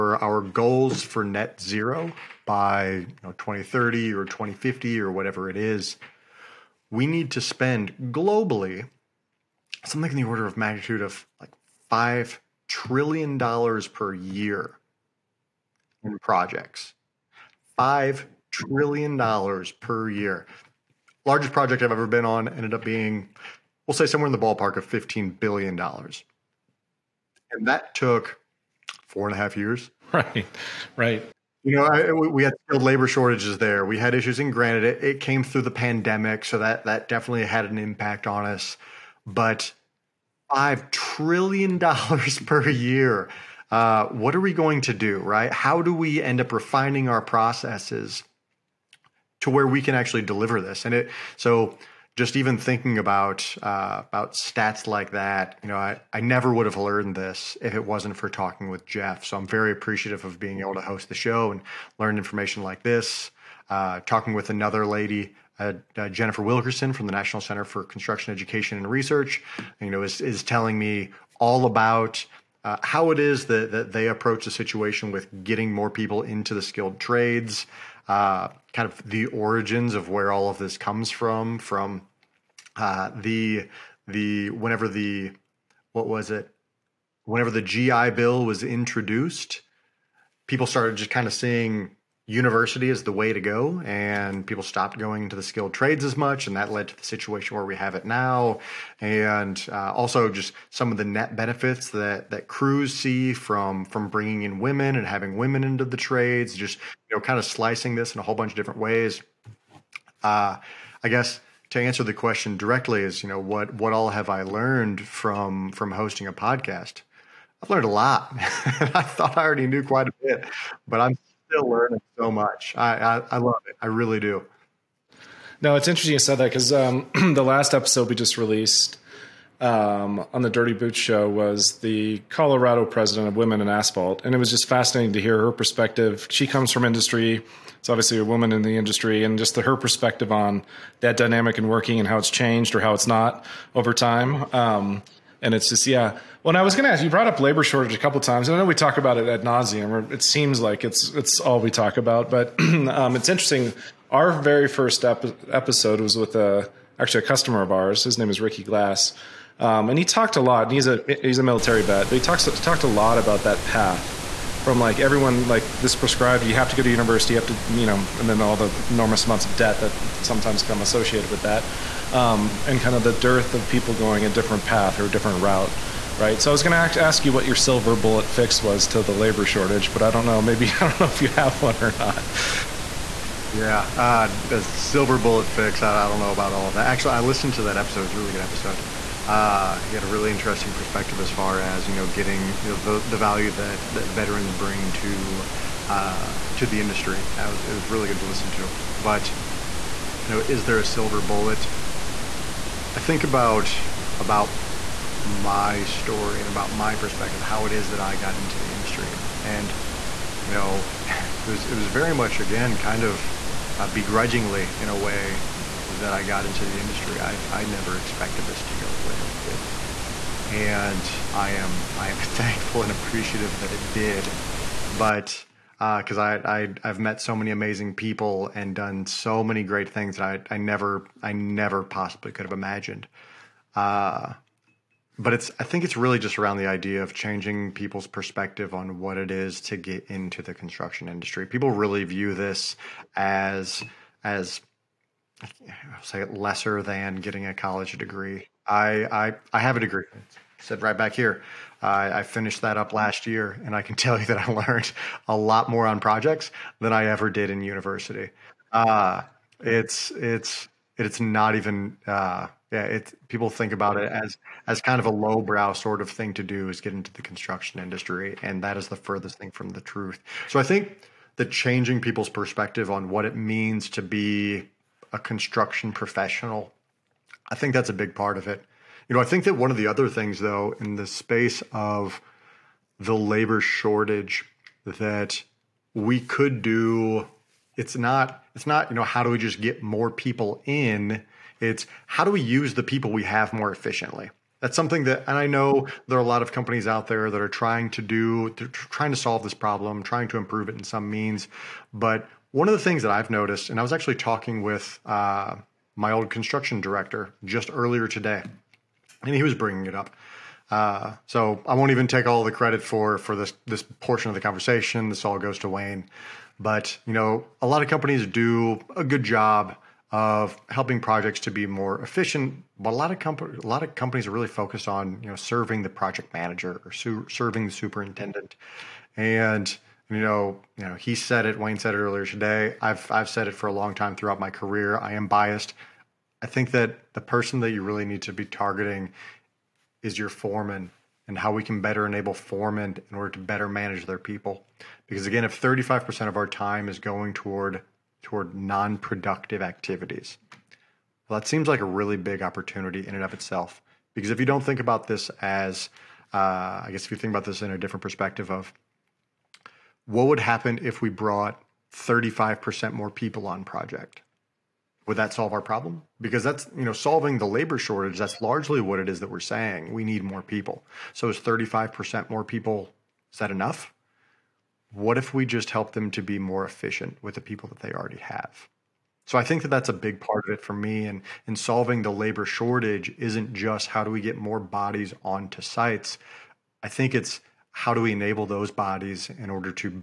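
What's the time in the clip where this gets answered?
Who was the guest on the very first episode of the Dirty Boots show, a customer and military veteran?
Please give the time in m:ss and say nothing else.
2:38.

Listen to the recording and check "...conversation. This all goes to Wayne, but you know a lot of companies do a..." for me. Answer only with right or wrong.
right.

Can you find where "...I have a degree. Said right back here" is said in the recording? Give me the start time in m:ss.
4:09.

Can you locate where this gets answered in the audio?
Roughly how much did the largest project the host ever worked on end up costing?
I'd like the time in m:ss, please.
0:24.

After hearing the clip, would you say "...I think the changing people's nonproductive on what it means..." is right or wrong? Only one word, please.
wrong.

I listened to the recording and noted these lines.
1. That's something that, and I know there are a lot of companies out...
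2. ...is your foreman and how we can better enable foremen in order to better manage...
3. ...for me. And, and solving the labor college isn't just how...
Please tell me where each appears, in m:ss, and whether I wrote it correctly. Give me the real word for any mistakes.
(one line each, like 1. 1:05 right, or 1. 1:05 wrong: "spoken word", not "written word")
1. 4:54 right
2. 5:40 right
3. 6:20 wrong: "shortage", not "college".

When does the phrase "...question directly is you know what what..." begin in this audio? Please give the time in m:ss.
1:52.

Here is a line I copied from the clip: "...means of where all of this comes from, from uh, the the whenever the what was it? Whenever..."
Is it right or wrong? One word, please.
wrong.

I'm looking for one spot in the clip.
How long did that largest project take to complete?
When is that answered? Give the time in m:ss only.
0:29.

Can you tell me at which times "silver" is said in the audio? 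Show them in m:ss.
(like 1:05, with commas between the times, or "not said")
2:57, 3:04, 3:20.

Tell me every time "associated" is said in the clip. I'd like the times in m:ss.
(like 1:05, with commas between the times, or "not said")
2:50.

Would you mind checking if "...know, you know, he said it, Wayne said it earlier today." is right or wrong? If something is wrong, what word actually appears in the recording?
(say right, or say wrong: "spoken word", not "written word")
right.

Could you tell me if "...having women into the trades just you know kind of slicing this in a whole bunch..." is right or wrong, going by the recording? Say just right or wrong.
right.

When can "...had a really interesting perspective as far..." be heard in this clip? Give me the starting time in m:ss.
3:09.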